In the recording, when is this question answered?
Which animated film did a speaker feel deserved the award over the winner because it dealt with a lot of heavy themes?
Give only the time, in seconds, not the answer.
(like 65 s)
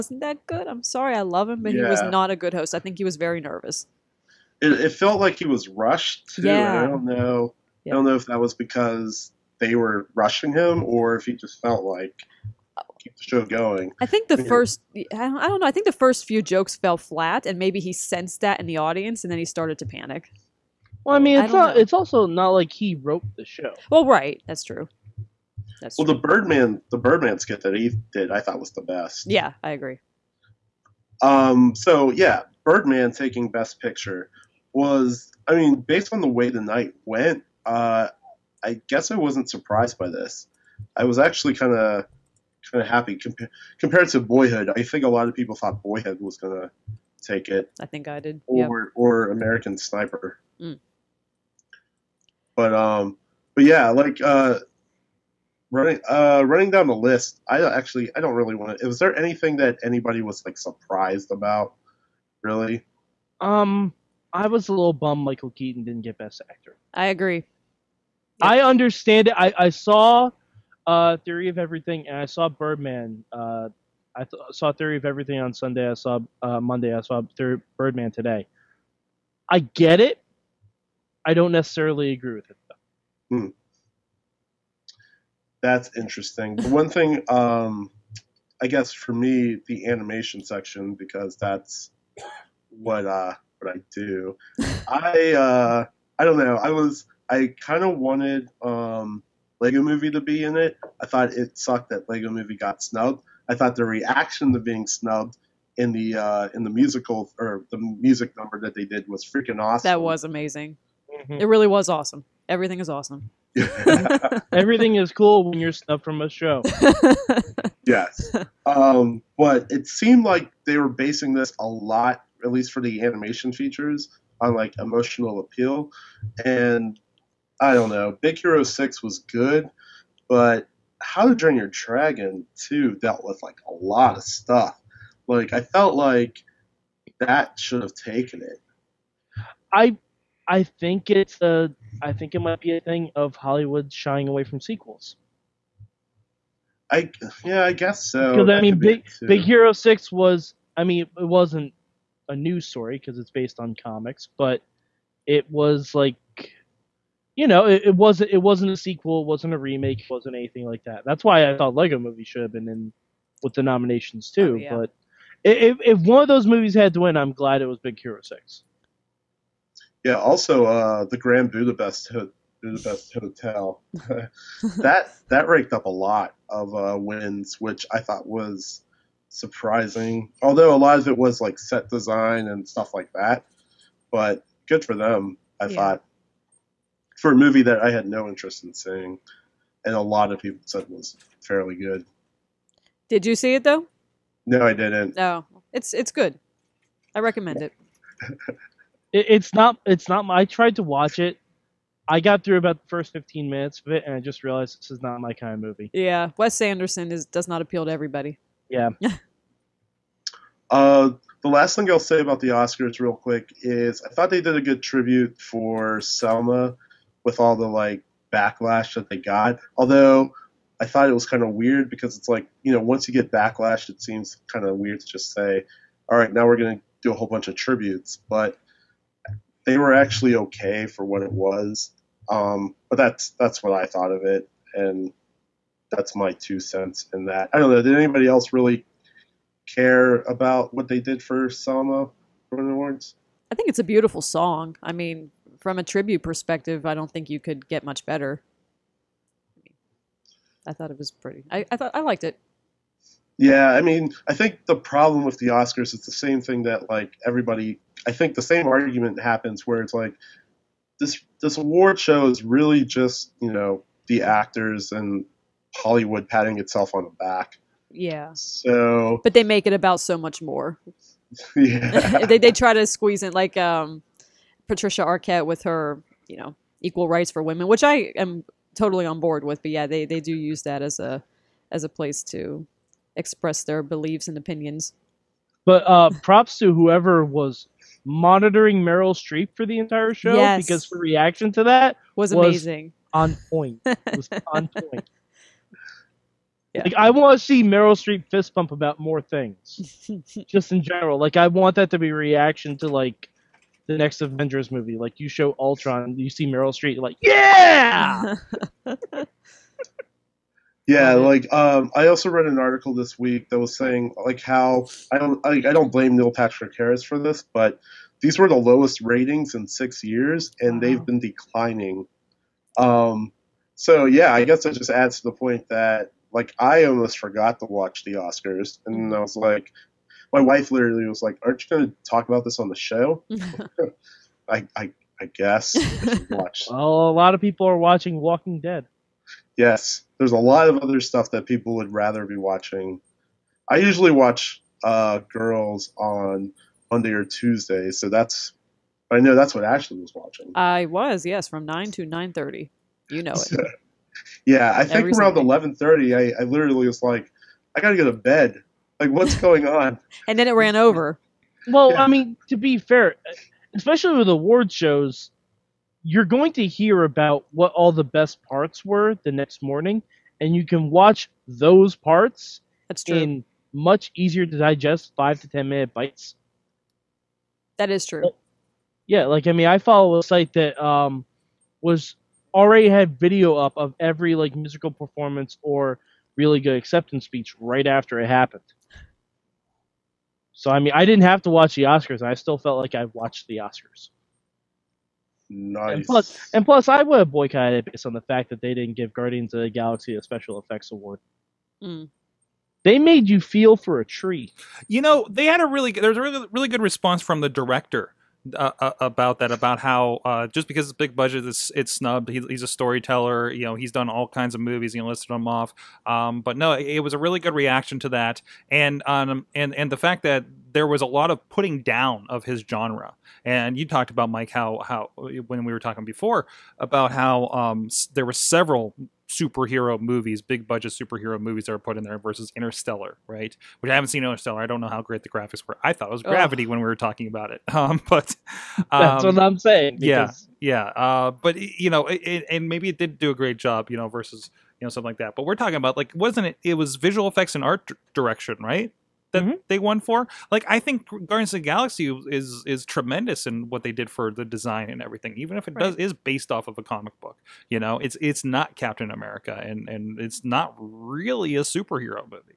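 131 s.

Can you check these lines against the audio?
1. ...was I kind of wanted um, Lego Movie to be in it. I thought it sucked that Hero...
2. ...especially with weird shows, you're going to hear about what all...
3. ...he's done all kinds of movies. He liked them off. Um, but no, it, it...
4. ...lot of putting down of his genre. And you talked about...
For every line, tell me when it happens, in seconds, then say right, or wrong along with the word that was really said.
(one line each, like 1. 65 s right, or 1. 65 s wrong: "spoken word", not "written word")
1. 96 s wrong: "Lego", not "Hero"
2. 363 s wrong: "award", not "weird"
3. 413 s wrong: "listed", not "liked"
4. 421 s right.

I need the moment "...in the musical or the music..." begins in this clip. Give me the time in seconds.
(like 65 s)
106 s.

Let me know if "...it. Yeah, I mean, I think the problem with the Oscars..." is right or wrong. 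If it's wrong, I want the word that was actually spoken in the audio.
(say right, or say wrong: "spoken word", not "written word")
right.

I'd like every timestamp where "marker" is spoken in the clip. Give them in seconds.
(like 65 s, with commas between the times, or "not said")
not said.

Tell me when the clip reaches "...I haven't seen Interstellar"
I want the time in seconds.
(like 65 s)
433 s.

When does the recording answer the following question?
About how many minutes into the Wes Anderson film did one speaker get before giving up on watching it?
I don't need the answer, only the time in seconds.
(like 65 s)
203 s.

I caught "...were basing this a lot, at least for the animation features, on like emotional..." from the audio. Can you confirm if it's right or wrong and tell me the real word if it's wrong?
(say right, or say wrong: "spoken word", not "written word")
right.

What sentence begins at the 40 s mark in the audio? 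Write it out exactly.
I was actually kind of kind of happy Compa- compared to Boyhood.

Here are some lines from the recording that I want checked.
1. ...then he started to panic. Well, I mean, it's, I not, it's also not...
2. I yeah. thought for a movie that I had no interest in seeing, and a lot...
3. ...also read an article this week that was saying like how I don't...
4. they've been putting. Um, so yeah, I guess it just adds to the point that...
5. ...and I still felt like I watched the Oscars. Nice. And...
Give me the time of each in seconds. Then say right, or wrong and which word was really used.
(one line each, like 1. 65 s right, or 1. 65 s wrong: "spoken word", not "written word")
1. 19 s right
2. 185 s right
3. 312 s right
4. 320 s wrong: "declining", not "putting"
5. 392 s right.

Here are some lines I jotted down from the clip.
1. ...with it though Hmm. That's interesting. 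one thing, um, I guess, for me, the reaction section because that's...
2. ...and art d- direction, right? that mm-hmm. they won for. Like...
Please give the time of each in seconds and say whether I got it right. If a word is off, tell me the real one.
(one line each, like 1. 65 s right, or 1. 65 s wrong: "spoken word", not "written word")
1. 82 s wrong: "animation", not "reaction"
2. 447 s right.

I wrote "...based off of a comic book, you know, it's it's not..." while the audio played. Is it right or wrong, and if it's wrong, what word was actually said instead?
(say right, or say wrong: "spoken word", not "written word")
right.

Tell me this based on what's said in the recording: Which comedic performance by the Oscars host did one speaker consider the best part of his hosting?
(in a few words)
Birdman skit.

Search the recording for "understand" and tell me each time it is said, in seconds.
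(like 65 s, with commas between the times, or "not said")
68 s.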